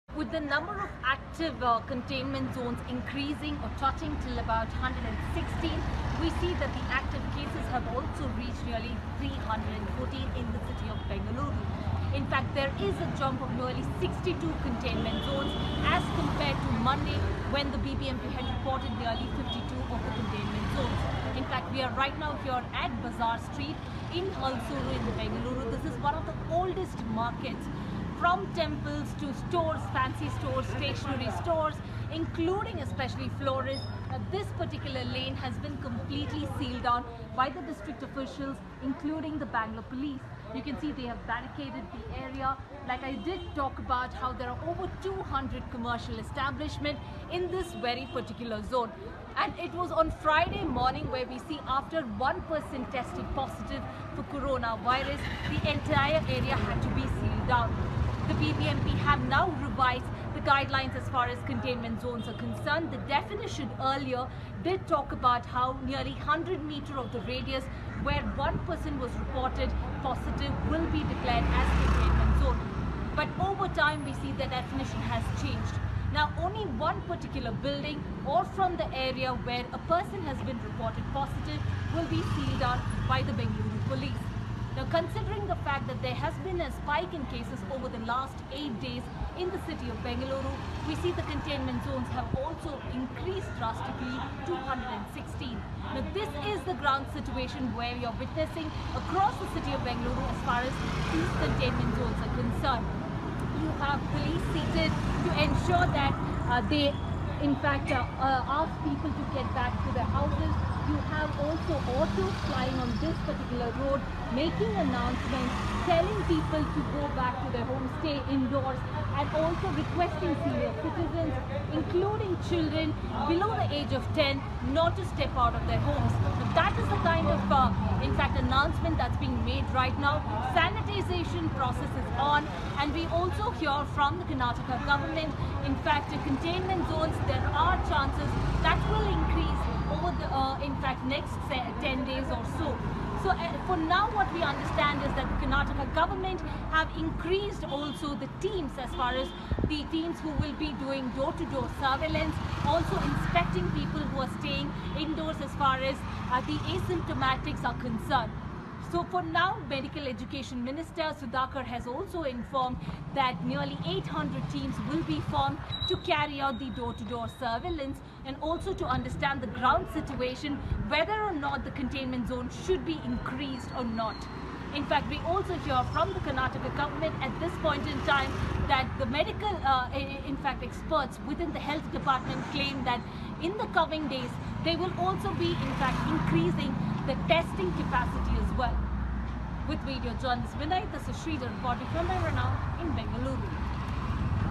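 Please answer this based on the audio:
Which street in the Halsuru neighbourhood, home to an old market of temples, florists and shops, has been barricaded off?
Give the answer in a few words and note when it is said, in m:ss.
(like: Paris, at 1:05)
Bazaar Street, at 0:23.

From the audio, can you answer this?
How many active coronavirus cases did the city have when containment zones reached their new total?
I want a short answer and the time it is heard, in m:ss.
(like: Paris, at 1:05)
314, at 0:09.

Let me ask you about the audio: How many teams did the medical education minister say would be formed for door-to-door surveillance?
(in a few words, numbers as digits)
800.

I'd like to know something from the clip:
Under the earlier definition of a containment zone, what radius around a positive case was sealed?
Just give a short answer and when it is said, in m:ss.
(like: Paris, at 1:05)
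100 meters, at 1:06.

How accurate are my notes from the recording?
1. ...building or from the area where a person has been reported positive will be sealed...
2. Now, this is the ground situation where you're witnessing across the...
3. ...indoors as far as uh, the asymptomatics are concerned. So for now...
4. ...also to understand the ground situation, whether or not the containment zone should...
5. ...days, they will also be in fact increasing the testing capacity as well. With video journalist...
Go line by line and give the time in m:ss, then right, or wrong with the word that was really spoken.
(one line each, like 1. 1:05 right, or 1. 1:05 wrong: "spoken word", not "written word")
1. 1:17 right
2. 1:35 right
3. 2:35 right
4. 2:48 right
5. 3:04 right.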